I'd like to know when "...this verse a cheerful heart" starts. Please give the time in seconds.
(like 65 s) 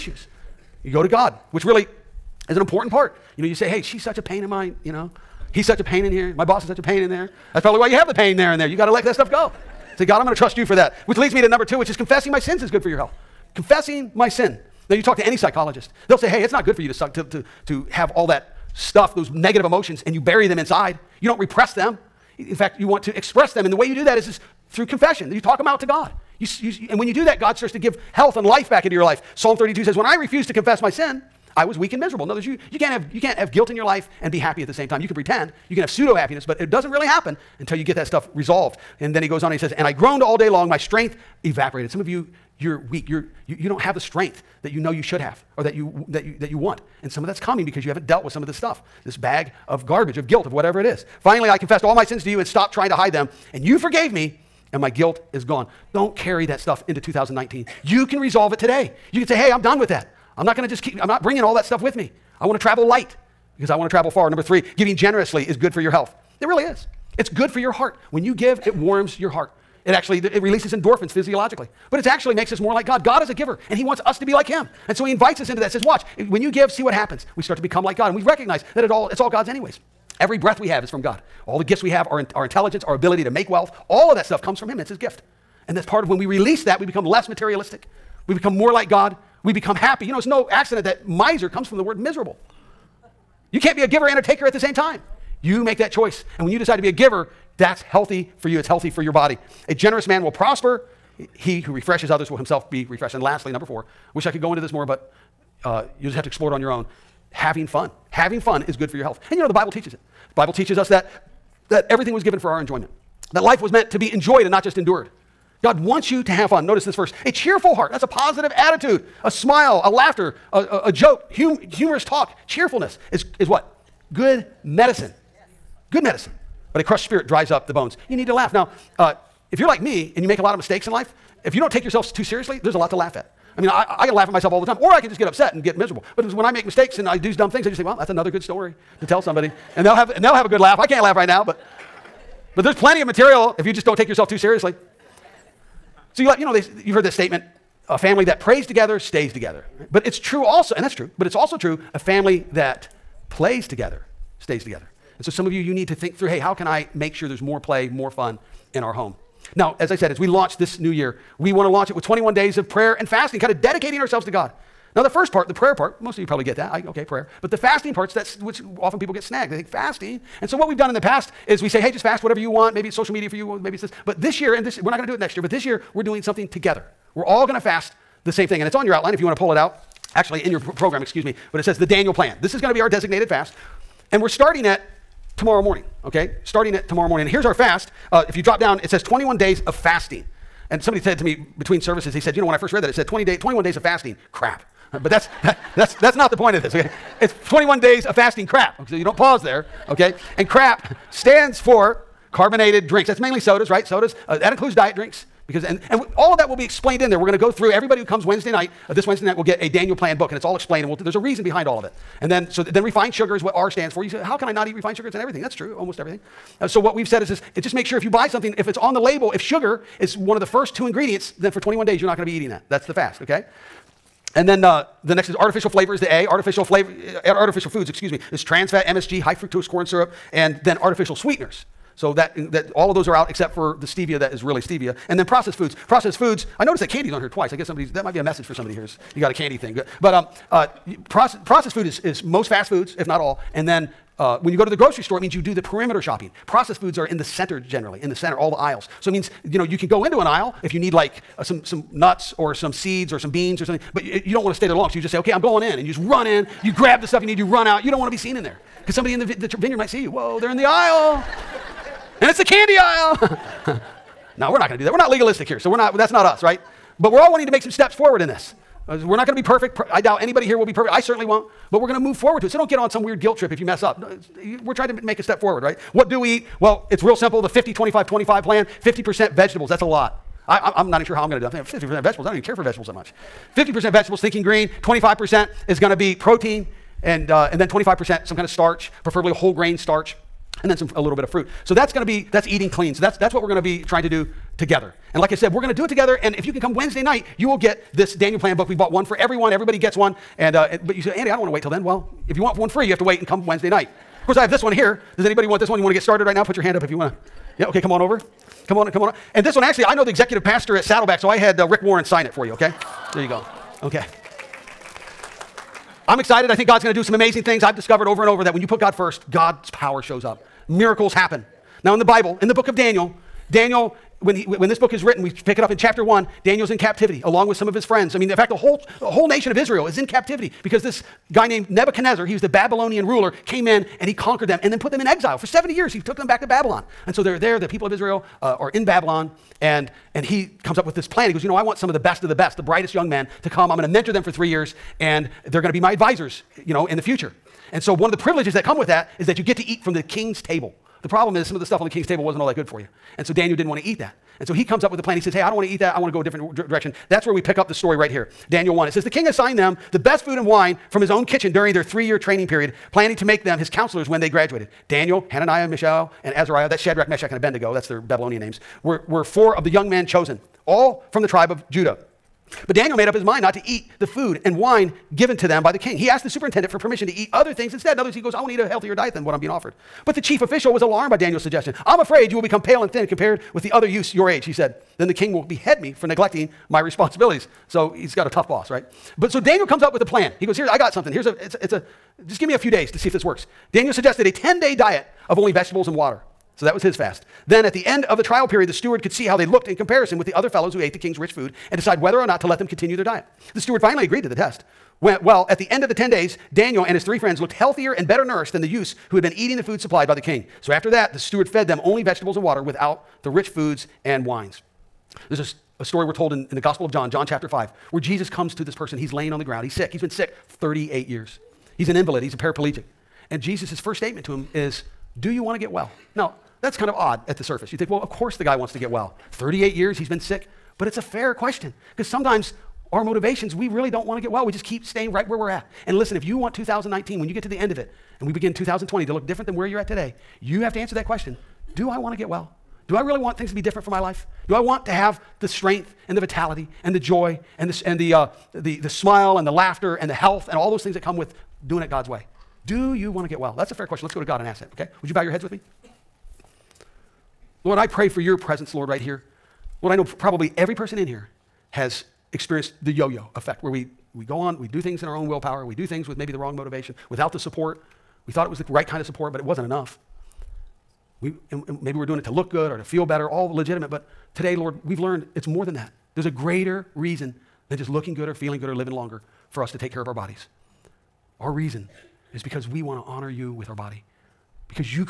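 116 s.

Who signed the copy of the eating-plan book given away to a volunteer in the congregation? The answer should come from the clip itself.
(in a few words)
Rick Warren.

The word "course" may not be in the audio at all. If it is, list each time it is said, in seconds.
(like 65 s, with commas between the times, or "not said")
304 s, 428 s.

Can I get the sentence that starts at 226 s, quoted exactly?
Artificial flavor, uh, artificial foods, excuse me, is trans fat, MSG, high fructose corn syrup, and then artificial sweeteners.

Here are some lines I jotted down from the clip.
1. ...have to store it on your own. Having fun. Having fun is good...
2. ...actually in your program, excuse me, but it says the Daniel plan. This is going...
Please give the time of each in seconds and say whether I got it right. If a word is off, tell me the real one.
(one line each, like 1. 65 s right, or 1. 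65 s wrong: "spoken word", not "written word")
1. 106 s wrong: "explore", not "store"
2. 180 s right.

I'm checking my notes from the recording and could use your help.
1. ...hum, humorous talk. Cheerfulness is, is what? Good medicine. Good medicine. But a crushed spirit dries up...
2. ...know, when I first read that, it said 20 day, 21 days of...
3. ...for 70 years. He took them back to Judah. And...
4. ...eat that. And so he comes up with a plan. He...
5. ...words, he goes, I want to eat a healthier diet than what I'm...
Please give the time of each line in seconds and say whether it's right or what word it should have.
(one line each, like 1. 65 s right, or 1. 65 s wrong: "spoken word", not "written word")
1. 121 s right
2. 192 s right
3. 335 s wrong: "Babylon", not "Judah"
4. 353 s right
5. 378 s right.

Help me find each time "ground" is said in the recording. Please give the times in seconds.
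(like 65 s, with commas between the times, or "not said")
419 s.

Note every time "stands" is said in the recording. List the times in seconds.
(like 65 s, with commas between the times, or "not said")
201 s, 213 s.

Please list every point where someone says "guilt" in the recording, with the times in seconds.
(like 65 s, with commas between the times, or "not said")
33 s, 50 s, 54 s, 273 s.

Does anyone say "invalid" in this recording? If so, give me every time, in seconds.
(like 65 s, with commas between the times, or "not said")
421 s.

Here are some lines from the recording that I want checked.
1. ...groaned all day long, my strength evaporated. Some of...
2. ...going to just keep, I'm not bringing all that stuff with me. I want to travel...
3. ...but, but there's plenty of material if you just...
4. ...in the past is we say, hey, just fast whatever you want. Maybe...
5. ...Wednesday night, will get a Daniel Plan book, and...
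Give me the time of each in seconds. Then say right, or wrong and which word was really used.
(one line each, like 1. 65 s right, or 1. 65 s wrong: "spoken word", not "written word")
1. 39 s right
2. 60 s right
3. 141 s right
4. 170 s right
5. 209 s right.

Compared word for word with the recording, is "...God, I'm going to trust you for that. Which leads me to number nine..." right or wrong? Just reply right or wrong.
wrong.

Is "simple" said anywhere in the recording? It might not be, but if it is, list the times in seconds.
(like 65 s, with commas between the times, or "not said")
277 s.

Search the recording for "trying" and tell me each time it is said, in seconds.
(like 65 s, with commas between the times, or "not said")
52 s, 274 s, 293 s.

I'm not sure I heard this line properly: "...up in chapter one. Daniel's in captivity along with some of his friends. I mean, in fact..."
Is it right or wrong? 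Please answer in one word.
right.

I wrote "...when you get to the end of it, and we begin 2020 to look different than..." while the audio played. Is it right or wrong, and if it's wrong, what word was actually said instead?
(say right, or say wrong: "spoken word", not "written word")
right.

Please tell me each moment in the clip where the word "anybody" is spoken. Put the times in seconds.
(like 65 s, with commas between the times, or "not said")
270 s, 305 s.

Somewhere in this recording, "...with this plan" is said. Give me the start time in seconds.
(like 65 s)
340 s.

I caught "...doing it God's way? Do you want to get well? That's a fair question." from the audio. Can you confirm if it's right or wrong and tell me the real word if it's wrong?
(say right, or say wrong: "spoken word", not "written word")
right.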